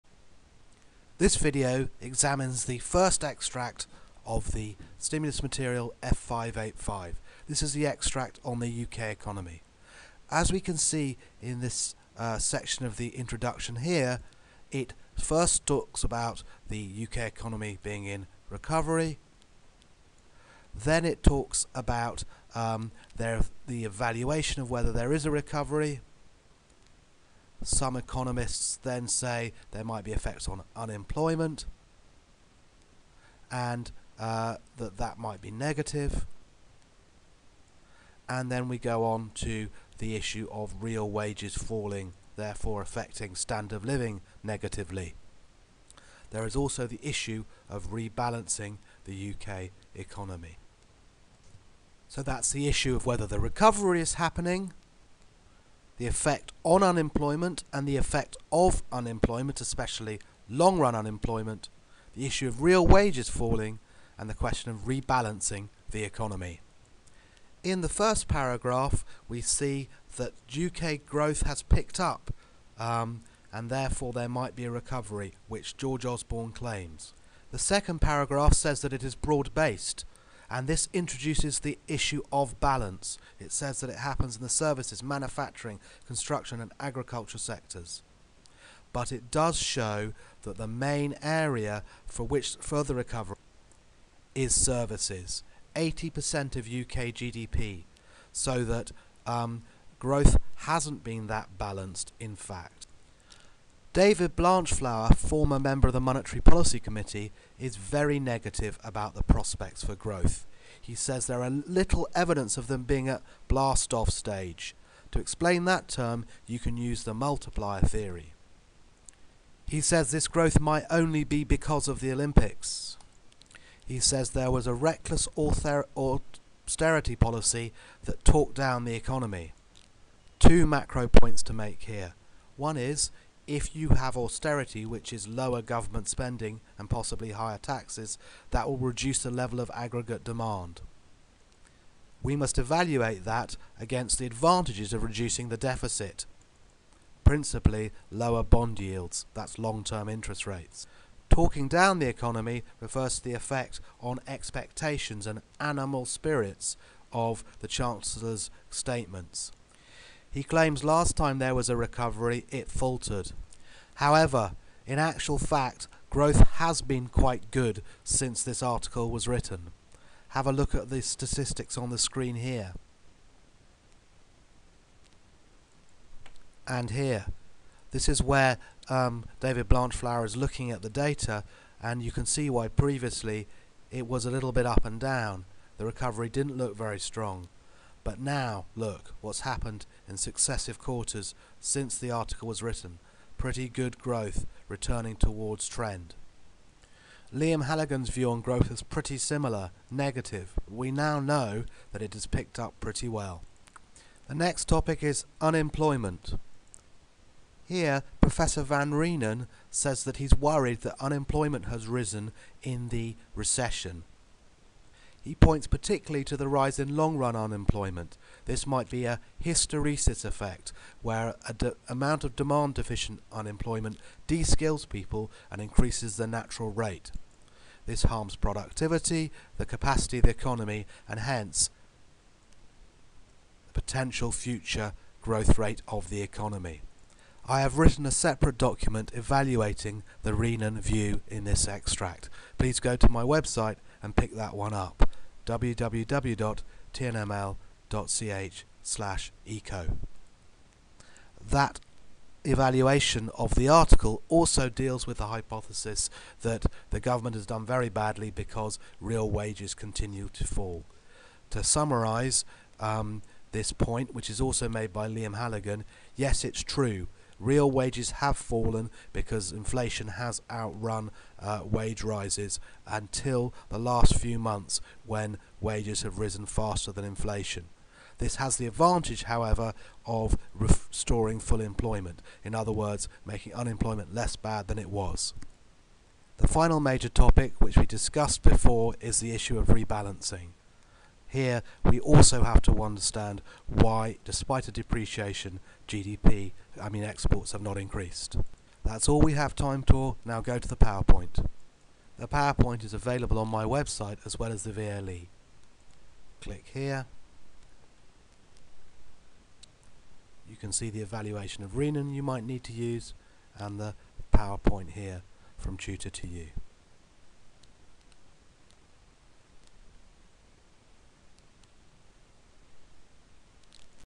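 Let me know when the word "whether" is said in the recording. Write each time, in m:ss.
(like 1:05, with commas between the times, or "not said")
0:24, 0:53.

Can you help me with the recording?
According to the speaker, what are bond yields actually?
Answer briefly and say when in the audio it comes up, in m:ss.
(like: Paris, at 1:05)
Long-term interest rates, at 2:29.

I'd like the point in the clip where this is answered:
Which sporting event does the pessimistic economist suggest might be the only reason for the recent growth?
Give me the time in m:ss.
2:01.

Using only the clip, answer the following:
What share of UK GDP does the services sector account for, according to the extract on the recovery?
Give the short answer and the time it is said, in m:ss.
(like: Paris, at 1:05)
80%, at 1:35.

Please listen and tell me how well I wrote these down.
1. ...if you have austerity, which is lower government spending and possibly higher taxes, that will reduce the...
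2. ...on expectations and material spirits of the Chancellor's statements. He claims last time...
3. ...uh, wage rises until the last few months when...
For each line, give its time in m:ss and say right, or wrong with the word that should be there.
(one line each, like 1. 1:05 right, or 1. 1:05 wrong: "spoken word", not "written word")
1. 2:13 right
2. 2:34 wrong: "animal", not "material"
3. 4:31 right.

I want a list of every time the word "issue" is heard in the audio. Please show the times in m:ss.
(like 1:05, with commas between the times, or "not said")
0:40, 0:47, 0:52, 1:02, 1:21, 4:49.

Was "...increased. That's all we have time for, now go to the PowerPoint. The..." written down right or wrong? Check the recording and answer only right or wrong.
right.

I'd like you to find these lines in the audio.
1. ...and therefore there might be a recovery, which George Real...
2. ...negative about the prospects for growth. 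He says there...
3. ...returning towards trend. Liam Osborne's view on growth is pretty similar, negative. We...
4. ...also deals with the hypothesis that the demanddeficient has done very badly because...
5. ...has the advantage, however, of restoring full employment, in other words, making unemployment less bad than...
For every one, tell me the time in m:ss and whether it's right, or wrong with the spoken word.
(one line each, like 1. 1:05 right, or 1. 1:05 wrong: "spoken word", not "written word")
1. 1:13 wrong: "Osborne", not "Real"
2. 1:48 right
3. 3:14 wrong: "Halligan", not "Osborne"
4. 4:14 wrong: "government", not "demanddeficient"
5. 4:38 right.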